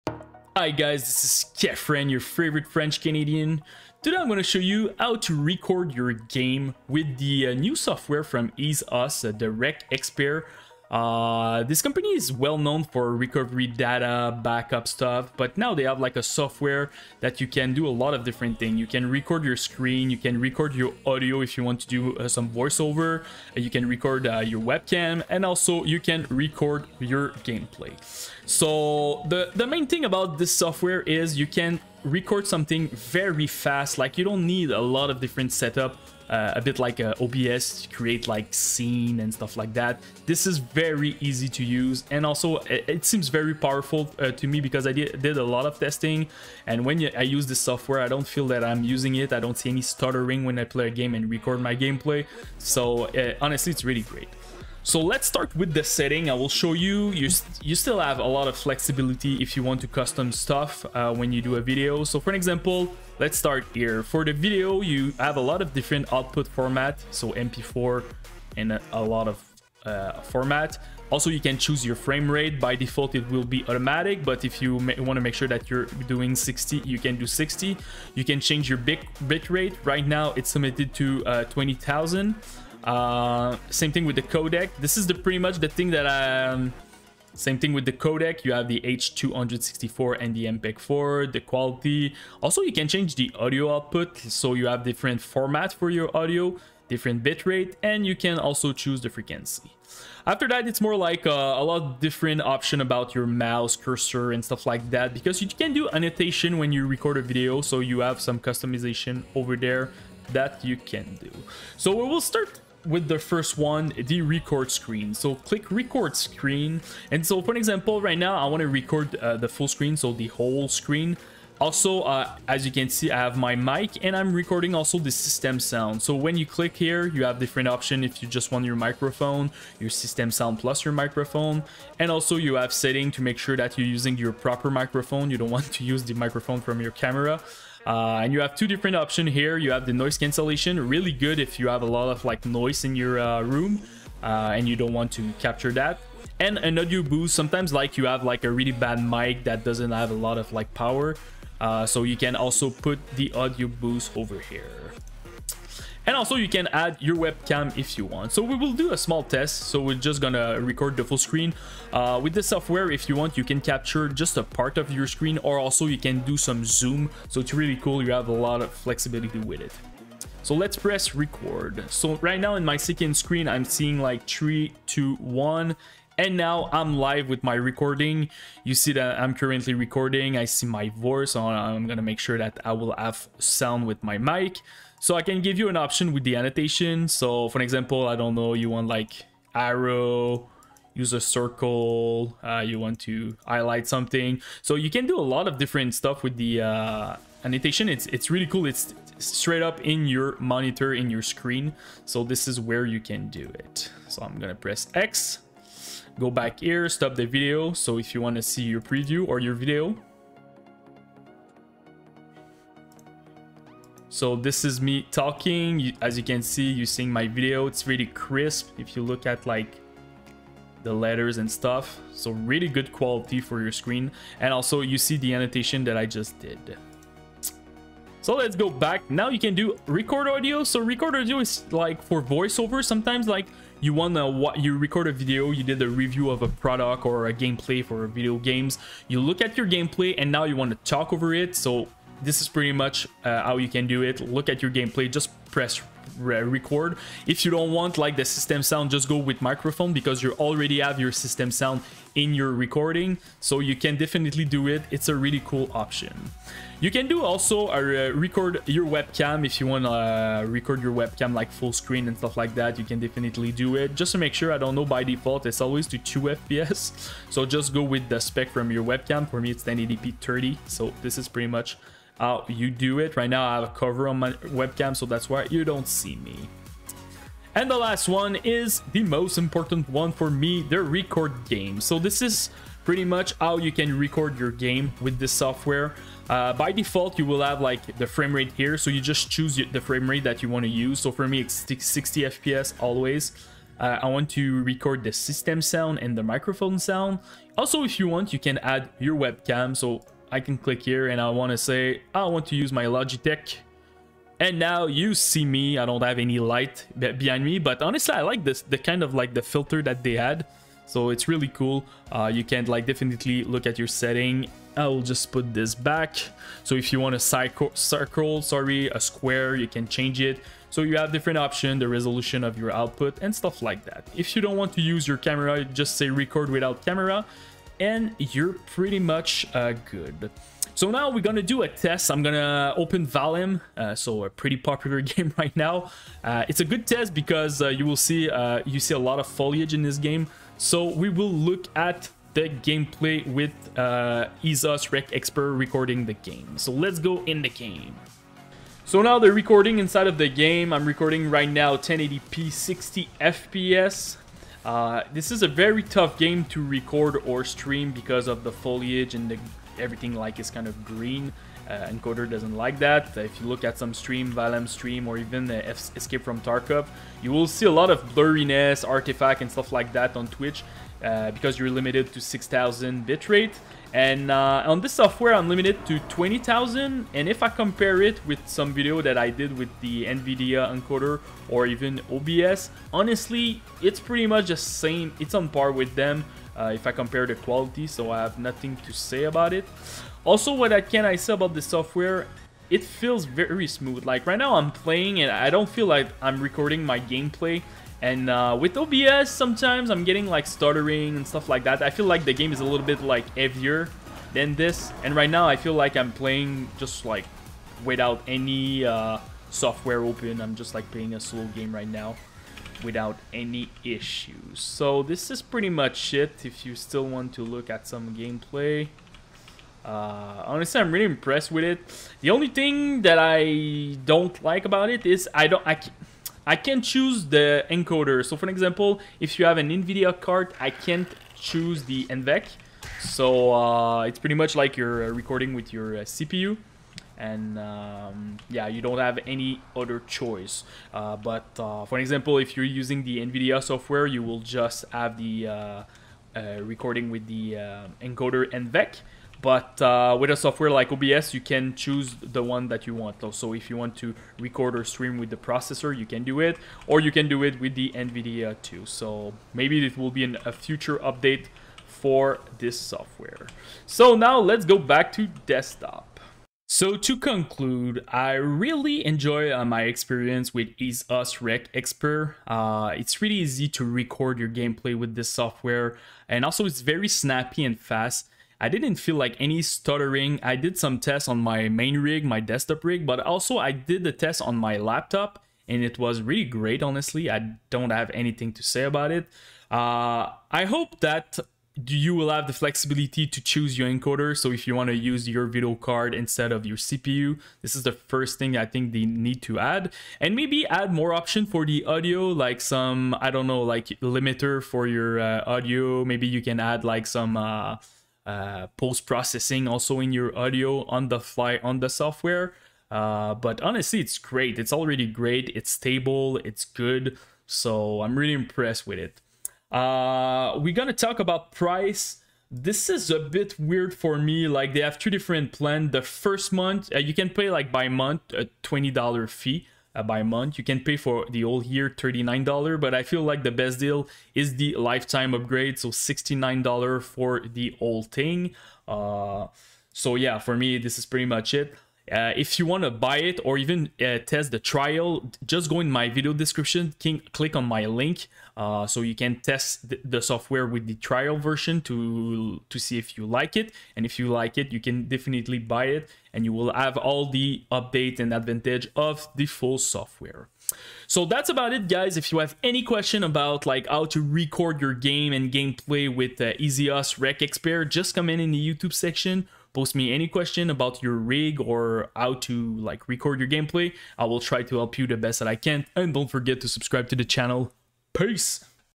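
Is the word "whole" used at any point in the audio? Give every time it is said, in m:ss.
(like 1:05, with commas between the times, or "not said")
2:00, 8:51, 8:57.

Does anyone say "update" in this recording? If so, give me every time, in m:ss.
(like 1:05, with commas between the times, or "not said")
7:40, 9:17.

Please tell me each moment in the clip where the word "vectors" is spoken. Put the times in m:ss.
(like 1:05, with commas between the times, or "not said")
not said.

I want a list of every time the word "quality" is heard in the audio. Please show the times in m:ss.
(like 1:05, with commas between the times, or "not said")
1:31, 3:42, 6:27.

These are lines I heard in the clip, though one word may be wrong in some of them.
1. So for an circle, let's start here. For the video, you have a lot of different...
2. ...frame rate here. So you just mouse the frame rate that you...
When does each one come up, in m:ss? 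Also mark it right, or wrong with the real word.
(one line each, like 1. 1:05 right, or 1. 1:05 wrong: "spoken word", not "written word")
1. 1:02 wrong: "example", not "circle"
2. 4:48 wrong: "choose", not "mouse".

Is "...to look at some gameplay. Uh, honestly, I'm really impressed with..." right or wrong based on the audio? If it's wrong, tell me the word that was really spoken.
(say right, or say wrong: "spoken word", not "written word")
right.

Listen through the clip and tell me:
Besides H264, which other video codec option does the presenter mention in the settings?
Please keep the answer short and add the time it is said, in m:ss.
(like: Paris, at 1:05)
MPEG-4, at 1:30.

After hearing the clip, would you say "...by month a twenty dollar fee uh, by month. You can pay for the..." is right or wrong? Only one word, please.
right.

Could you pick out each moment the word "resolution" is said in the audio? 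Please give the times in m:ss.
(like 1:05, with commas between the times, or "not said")
5:21.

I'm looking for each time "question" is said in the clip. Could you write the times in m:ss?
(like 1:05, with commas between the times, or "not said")
9:22, 9:30.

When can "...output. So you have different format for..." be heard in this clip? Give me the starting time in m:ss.
1:33.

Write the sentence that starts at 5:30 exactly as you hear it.
So now we're gonna do a test.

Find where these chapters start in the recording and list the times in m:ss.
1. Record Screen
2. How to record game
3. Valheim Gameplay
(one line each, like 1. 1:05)
1. 1:55
2. 4:41
3. 5:49.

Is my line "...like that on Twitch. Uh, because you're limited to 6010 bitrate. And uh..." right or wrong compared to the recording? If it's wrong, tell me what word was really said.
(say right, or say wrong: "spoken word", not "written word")
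wrong: "6000", not "6010".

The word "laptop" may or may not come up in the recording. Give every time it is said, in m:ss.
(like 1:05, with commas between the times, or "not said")
8:04.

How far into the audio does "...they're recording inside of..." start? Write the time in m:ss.
5:49.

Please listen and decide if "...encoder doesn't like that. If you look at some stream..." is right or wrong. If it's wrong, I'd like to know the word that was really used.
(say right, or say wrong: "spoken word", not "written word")
right.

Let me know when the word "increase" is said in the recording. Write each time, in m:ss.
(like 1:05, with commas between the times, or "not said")
not said.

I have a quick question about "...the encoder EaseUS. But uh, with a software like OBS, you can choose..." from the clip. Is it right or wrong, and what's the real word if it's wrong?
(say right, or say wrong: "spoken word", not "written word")
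wrong: "NVENC", not "EaseUS".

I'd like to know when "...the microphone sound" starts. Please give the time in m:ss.
4:56.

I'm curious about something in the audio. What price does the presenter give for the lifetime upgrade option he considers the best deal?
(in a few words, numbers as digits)
$69.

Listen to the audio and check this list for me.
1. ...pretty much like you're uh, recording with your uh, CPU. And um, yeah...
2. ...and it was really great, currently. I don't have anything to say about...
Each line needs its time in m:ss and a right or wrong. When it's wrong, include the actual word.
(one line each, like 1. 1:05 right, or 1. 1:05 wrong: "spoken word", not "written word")
1. 7:14 right
2. 8:05 wrong: "honestly", not "currently".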